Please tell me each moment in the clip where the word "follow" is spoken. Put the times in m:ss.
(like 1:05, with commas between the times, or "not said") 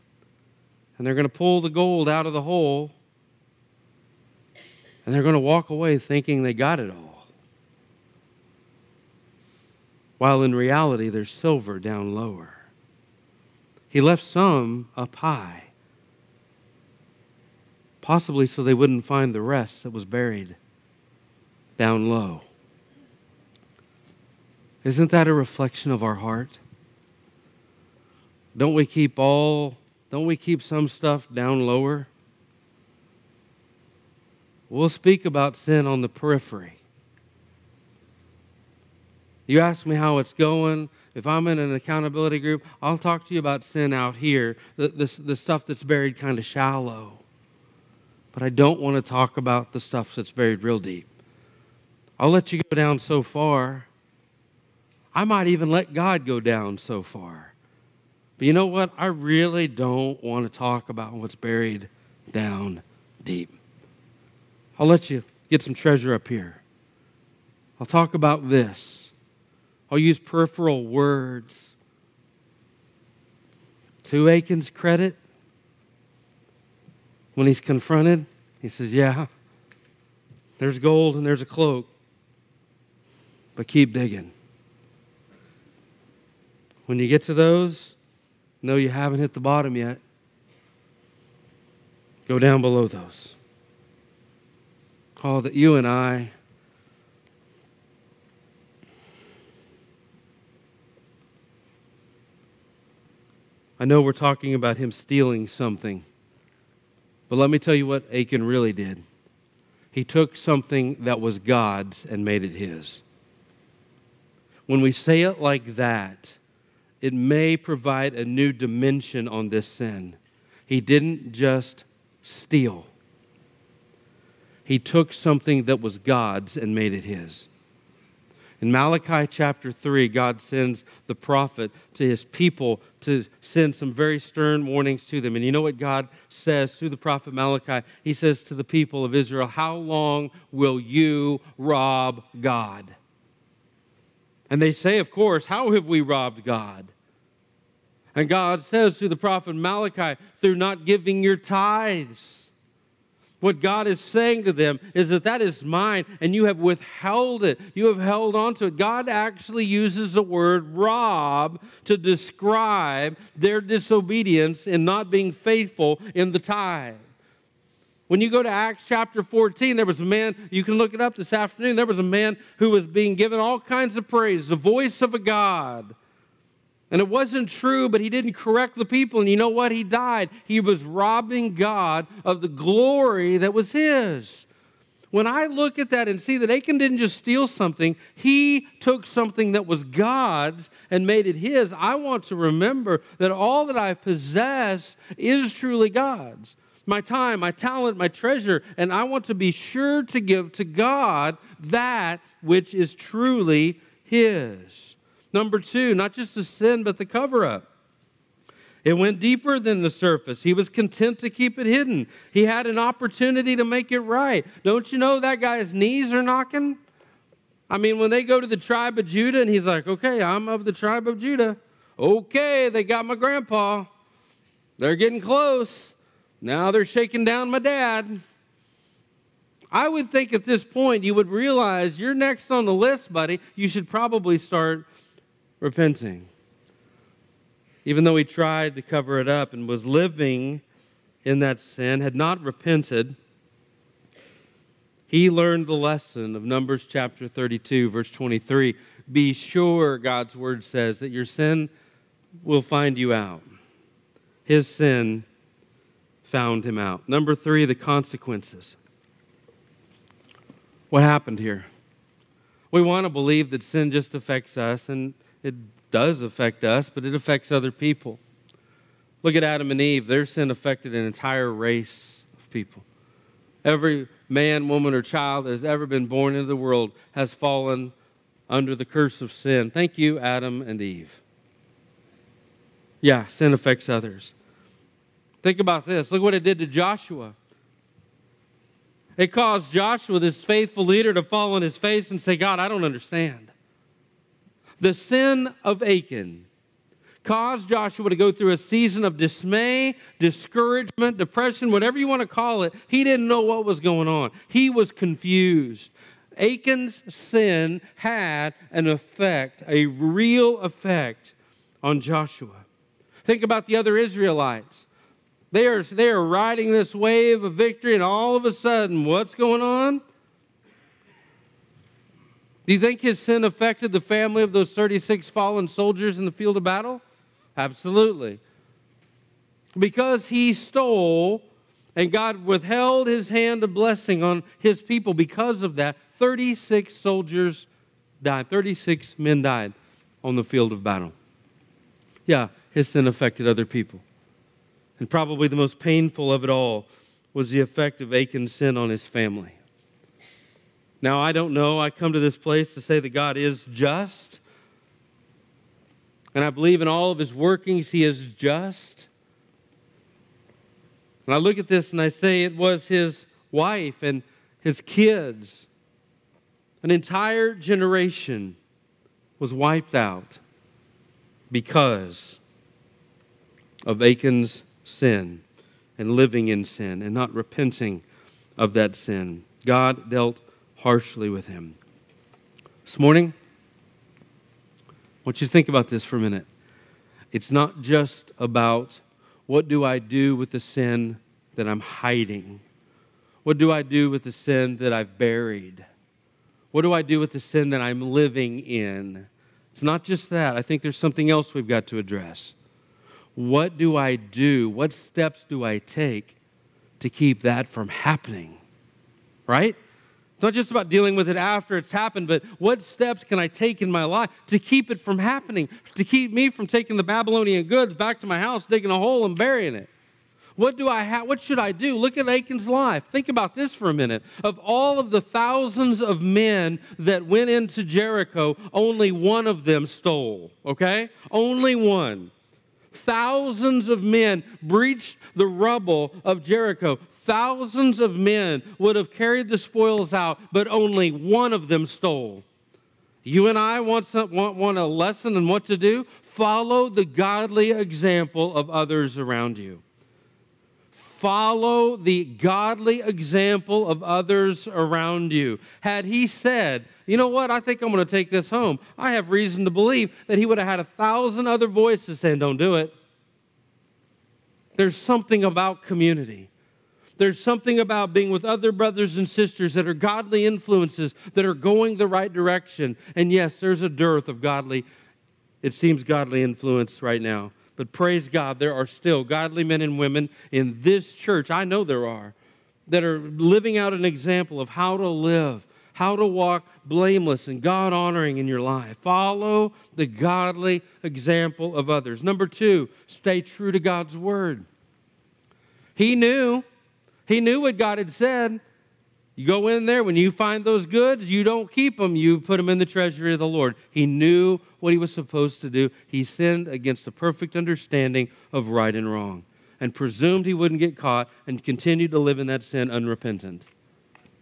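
7:26, 7:31, 8:09.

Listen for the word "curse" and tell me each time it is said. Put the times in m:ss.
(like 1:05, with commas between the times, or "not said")
4:38.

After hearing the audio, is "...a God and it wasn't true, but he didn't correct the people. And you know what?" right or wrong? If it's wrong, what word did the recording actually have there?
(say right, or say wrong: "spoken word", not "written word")
right.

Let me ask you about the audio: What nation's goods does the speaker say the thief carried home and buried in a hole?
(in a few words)
Babylonian.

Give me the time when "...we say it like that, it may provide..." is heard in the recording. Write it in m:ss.
1:54.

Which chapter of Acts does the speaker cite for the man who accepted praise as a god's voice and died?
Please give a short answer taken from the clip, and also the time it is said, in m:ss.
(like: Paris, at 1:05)
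Acts chapter 14, at 2:48.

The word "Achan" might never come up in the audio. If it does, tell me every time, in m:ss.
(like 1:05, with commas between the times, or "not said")
1:14, 1:48, 3:06, 4:55, 5:06, 5:48, 6:14, 7:02.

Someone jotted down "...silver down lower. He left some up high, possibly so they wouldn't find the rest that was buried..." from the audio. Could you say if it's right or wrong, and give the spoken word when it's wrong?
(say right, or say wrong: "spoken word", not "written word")
right.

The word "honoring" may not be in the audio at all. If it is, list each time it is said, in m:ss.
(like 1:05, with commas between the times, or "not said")
8:07.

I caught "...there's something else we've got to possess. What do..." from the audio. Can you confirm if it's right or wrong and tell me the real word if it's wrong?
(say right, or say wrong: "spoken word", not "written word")
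wrong: "address", not "possess".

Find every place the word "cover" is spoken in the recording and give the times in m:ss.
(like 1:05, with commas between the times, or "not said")
3:27, 3:58.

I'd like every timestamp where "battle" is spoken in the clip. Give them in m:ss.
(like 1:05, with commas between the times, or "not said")
5:26, 5:40.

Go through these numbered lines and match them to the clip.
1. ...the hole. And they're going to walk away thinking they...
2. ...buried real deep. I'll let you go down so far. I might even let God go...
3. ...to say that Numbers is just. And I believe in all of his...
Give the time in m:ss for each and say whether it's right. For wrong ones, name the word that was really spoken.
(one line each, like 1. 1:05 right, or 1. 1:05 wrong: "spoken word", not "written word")
1. 0:02 right
2. 0:50 right
3. 5:52 wrong: "God", not "Numbers".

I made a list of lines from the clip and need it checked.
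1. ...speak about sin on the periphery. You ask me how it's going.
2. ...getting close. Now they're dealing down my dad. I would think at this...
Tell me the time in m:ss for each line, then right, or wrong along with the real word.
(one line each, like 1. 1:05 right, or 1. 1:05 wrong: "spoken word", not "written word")
1. 0:34 right
2. 3:44 wrong: "shaking", not "dealing".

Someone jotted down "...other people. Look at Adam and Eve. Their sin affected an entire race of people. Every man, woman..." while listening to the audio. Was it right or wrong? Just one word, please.
right.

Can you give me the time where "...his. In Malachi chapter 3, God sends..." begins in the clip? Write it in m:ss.
2:07.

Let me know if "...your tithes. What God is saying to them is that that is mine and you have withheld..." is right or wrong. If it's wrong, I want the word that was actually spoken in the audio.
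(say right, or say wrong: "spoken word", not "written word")
right.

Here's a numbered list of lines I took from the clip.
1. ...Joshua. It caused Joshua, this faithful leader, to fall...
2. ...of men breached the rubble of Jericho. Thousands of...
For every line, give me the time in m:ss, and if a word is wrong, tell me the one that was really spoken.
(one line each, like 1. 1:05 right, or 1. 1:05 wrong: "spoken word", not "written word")
1. 4:46 right
2. 7:13 right.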